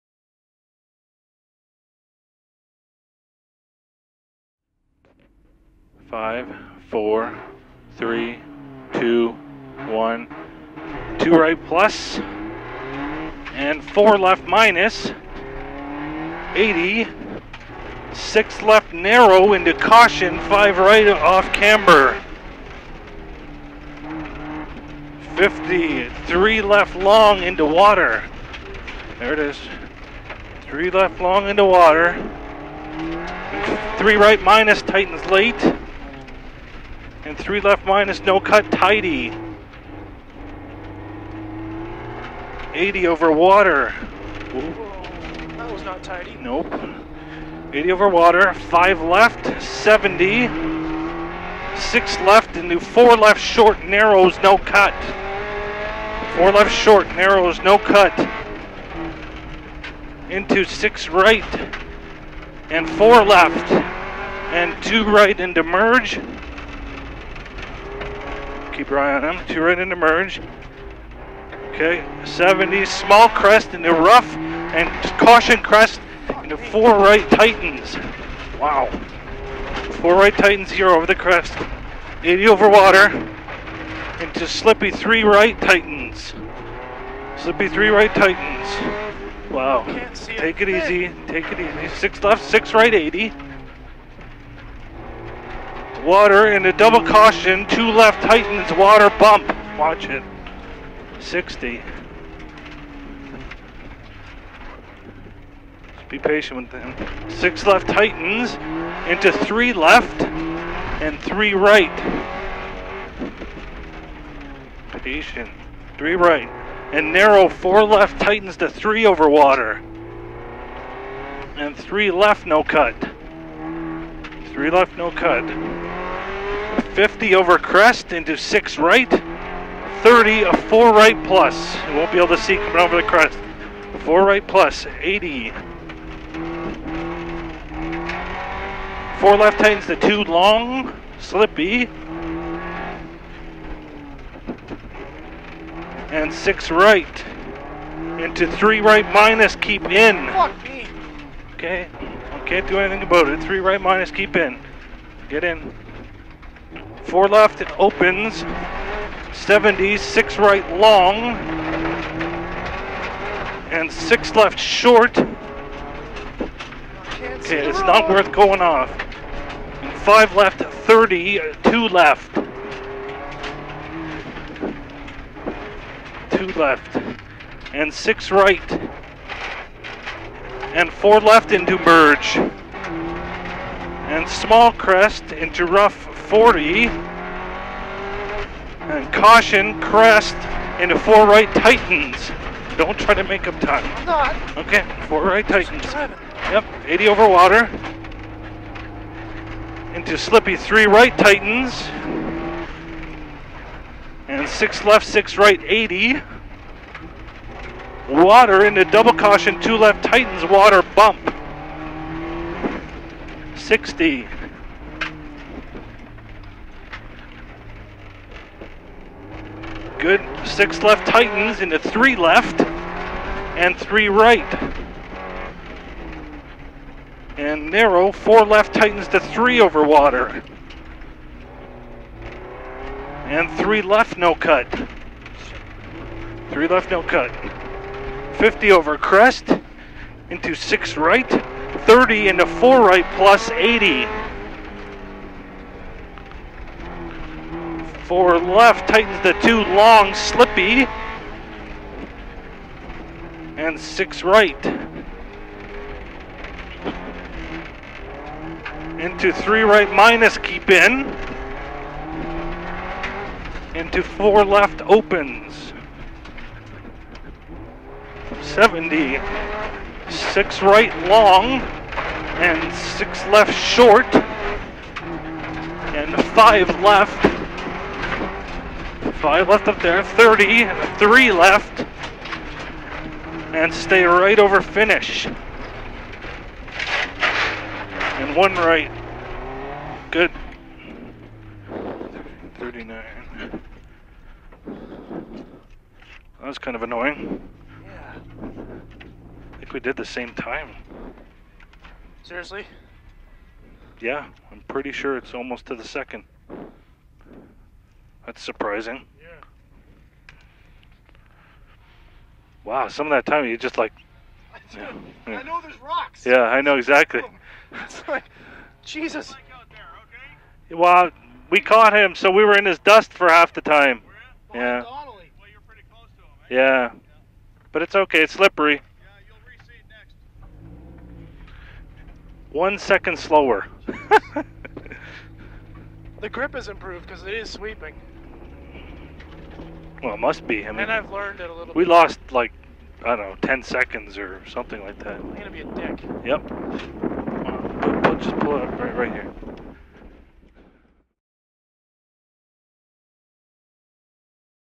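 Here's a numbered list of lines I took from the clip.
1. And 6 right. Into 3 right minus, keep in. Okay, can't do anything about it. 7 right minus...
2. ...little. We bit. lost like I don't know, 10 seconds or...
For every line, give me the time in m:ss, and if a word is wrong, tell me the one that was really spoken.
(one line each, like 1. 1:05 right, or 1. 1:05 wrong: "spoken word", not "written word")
1. 2:26 wrong: "3", not "7"
2. 5:41 right.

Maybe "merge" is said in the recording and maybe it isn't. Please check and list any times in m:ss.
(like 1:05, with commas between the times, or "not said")
1:05, 1:09, 3:01.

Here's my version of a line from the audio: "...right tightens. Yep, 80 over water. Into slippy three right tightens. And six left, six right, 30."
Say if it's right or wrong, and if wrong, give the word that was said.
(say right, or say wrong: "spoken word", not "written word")
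wrong: "80", not "30".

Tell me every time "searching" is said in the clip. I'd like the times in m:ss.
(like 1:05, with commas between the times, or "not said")
not said.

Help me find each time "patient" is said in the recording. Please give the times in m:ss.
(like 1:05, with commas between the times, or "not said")
1:46, 1:55.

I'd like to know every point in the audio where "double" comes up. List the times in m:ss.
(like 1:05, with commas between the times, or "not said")
1:36, 3:28.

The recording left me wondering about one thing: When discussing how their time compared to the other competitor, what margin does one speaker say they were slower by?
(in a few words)
One second.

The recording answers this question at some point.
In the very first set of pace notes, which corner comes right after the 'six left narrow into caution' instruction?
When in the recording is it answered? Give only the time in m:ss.
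0:20.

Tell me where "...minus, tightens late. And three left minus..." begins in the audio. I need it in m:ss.
0:34.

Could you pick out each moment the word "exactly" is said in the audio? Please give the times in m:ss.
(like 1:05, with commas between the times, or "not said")
5:16.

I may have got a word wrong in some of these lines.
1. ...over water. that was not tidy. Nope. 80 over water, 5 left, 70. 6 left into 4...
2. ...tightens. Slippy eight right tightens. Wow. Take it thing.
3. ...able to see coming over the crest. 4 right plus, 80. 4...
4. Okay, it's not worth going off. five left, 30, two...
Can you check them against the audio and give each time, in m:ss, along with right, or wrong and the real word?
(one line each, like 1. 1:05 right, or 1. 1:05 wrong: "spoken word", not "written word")
1. 0:43 right
2. 1:25 wrong: "three", not "eight"
3. 2:12 right
4. 2:45 right.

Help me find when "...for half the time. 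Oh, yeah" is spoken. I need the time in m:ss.
5:23.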